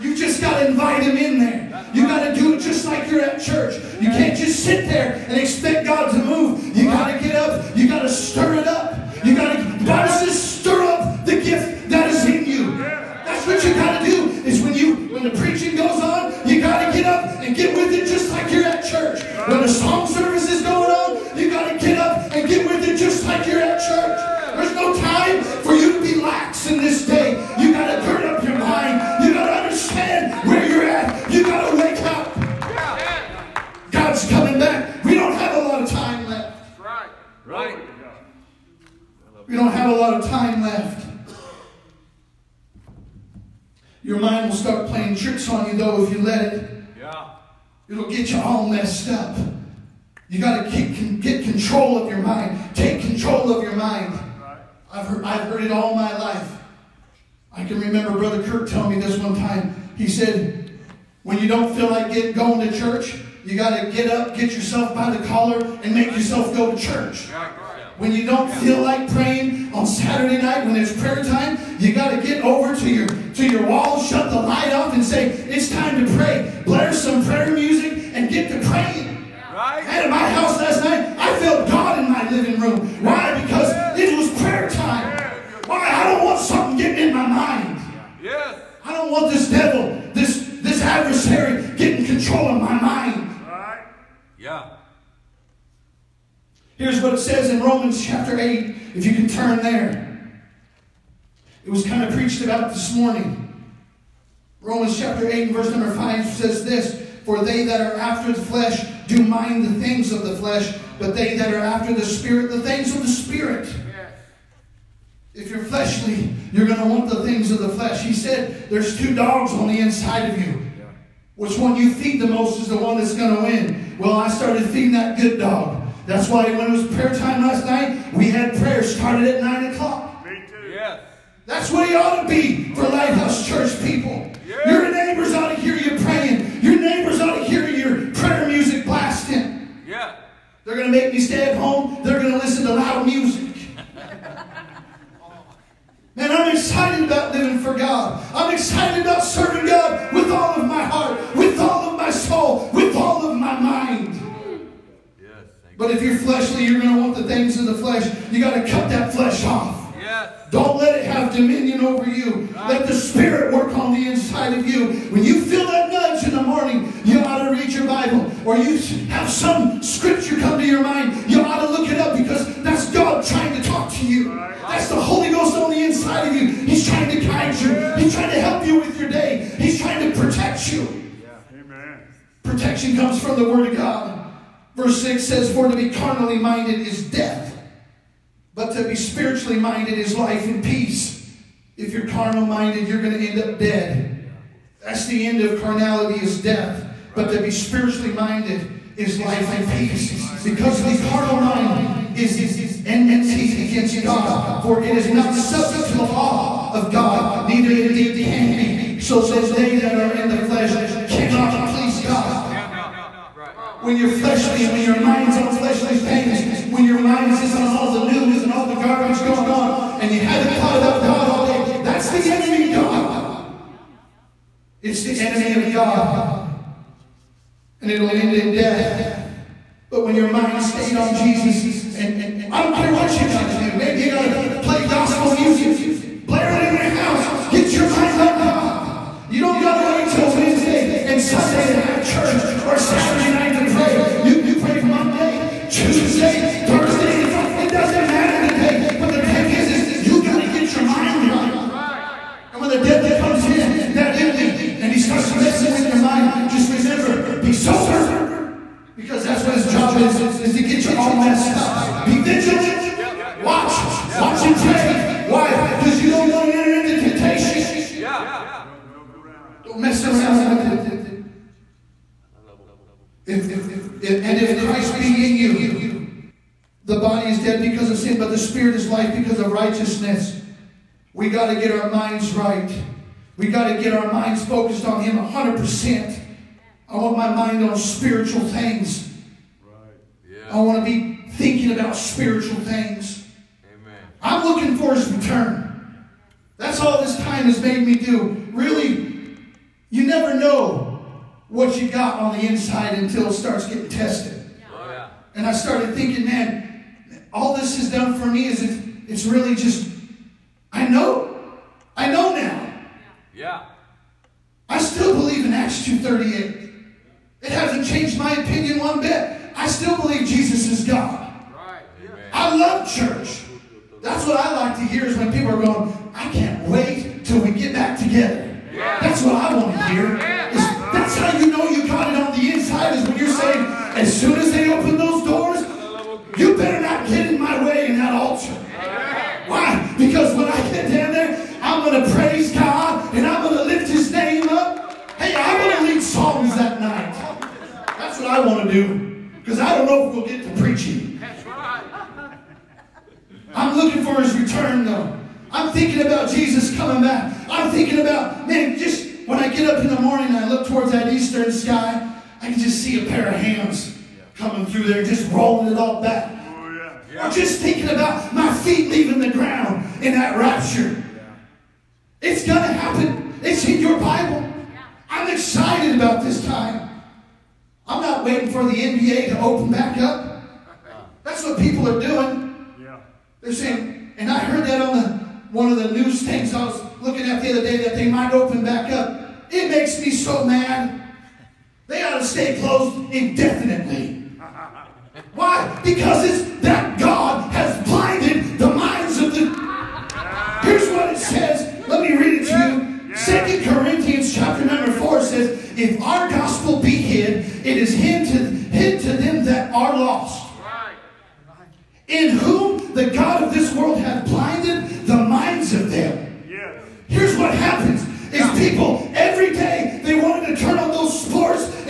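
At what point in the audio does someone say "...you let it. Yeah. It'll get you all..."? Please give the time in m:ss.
0:46.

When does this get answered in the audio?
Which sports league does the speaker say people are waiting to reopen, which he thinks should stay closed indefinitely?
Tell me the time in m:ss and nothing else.
6:18.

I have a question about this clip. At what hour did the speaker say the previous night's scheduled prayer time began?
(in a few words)
9 o'clock.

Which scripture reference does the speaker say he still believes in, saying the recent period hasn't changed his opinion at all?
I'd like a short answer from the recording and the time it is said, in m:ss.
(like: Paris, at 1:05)
Acts 2:38, at 5:15.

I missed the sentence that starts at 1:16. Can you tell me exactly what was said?
Blare some prayer music and get to praying.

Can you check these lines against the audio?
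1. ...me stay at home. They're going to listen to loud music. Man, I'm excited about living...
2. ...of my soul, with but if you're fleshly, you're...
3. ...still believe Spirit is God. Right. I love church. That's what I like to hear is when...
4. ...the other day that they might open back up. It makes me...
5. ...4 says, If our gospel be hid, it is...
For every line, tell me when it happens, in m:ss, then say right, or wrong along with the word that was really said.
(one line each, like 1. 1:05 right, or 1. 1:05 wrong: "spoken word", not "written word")
1. 2:21 right
2. 2:31 right
3. 5:19 wrong: "Jesus", not "Spirit"
4. 6:27 right
5. 6:44 right.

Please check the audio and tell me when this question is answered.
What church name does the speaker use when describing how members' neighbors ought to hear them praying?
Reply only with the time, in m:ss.
2:12.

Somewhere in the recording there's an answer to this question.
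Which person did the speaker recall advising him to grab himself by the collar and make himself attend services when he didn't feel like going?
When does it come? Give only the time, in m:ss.
0:58.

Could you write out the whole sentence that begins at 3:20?
Because the carnal mind is enmity against God, for it is not subject to the law of God, neither indeed can be.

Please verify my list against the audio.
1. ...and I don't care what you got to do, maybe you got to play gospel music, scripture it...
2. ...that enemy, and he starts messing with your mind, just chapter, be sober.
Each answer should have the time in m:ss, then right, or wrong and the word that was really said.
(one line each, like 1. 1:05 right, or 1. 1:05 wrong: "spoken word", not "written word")
1. 3:51 wrong: "blare", not "scripture"
2. 4:13 wrong: "remember", not "chapter".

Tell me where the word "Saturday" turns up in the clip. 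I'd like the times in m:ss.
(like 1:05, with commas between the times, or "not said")
1:09, 4:02.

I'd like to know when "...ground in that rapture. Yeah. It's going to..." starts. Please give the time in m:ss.
6:09.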